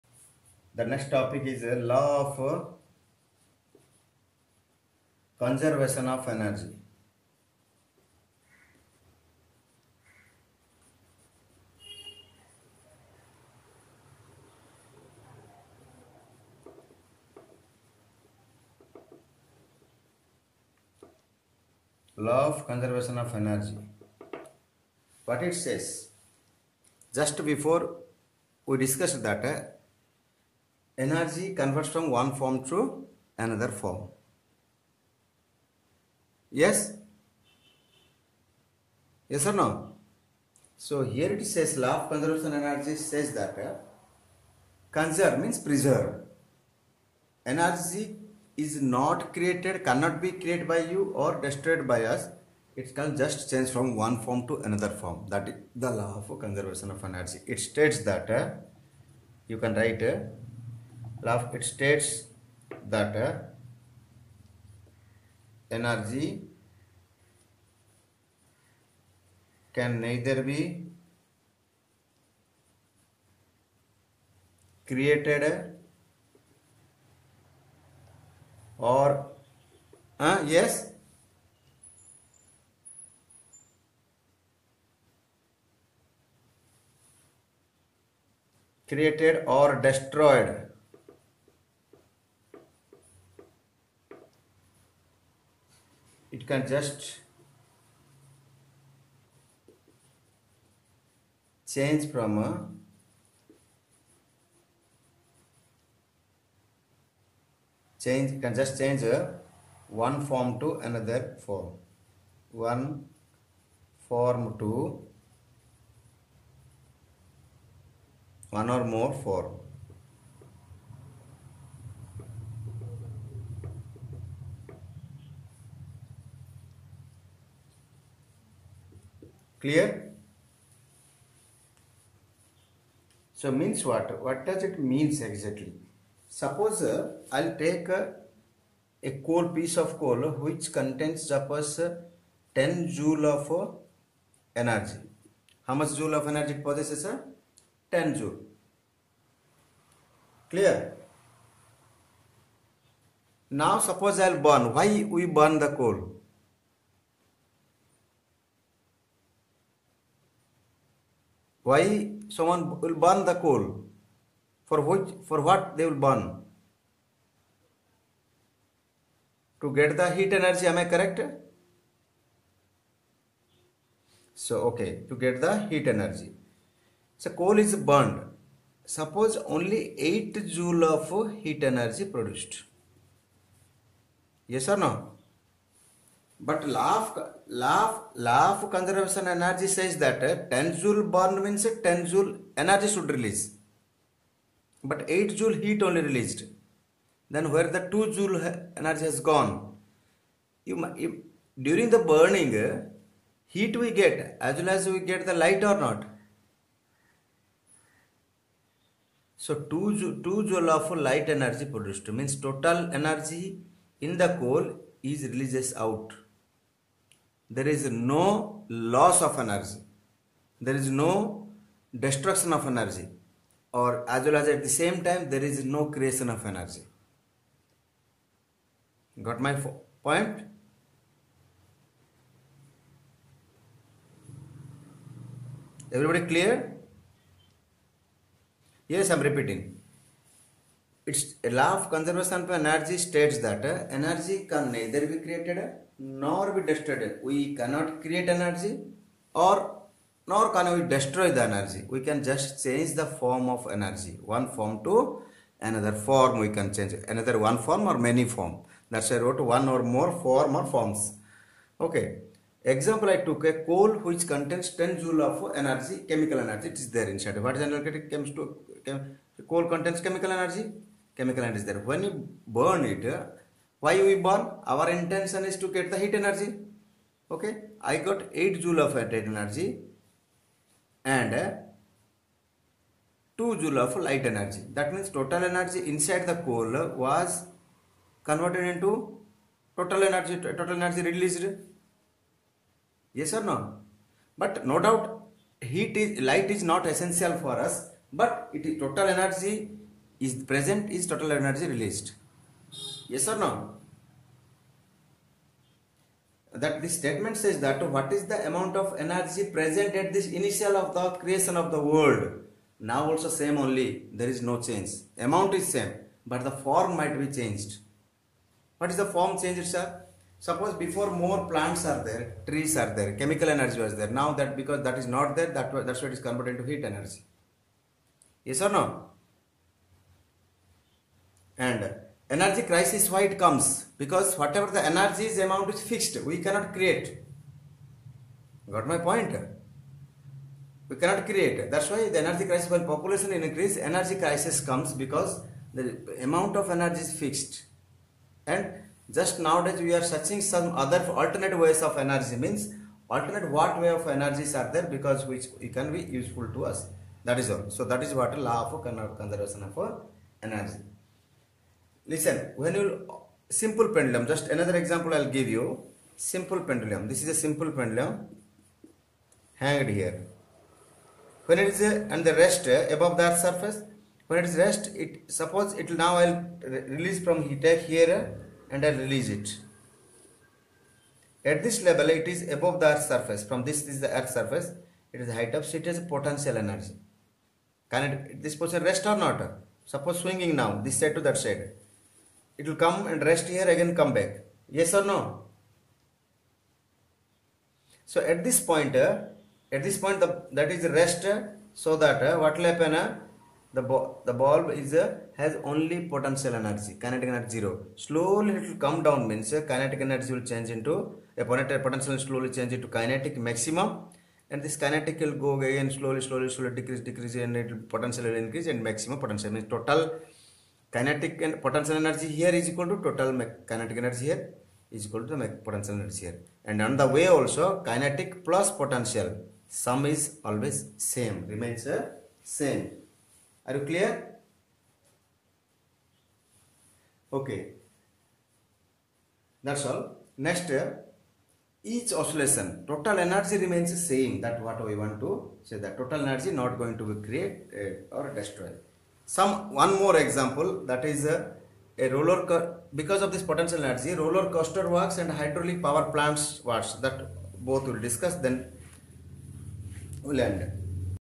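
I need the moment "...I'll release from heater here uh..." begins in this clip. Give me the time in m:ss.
6:16.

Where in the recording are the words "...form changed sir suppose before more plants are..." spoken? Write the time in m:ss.
5:19.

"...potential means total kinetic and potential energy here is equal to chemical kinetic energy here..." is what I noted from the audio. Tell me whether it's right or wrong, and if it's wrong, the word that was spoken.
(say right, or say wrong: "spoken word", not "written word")
wrong: "total", not "chemical".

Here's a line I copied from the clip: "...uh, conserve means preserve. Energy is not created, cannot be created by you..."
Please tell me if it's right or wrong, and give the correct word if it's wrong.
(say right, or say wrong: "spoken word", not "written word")
right.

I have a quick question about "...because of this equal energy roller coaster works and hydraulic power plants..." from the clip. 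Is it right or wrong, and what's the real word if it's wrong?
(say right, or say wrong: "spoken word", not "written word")
wrong: "potential", not "equal".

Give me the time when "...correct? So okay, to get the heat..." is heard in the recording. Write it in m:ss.
2:50.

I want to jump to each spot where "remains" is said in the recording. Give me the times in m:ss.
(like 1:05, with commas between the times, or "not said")
7:11, 7:23.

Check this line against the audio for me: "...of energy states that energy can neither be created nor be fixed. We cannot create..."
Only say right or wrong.
wrong.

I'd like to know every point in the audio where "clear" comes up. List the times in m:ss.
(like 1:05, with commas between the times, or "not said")
2:09, 2:30, 3:56, 7:13.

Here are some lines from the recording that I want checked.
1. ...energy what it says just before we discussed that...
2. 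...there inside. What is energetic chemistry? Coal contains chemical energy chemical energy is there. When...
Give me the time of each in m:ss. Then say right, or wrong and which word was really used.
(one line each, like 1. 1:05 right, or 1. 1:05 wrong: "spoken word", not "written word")
1. 0:23 right
2. 4:26 right.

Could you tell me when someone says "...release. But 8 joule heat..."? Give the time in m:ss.
3:13.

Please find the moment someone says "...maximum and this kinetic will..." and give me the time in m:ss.
6:53.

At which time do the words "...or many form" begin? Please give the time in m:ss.
4:17.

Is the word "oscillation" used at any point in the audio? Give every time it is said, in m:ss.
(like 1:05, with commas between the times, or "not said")
7:22.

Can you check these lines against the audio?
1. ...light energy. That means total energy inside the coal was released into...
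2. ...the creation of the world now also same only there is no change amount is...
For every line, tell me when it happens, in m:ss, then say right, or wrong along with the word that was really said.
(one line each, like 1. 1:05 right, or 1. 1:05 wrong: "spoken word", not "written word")
1. 4:43 wrong: "converted", not "released"
2. 5:10 right.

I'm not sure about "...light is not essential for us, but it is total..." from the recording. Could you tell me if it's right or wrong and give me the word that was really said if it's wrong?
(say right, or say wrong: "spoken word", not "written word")
right.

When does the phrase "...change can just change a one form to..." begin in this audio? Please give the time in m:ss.
1:48.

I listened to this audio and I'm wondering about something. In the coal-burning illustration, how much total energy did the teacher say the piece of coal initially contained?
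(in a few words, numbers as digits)
10 joules.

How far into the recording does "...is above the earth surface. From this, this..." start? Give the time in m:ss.
6:22.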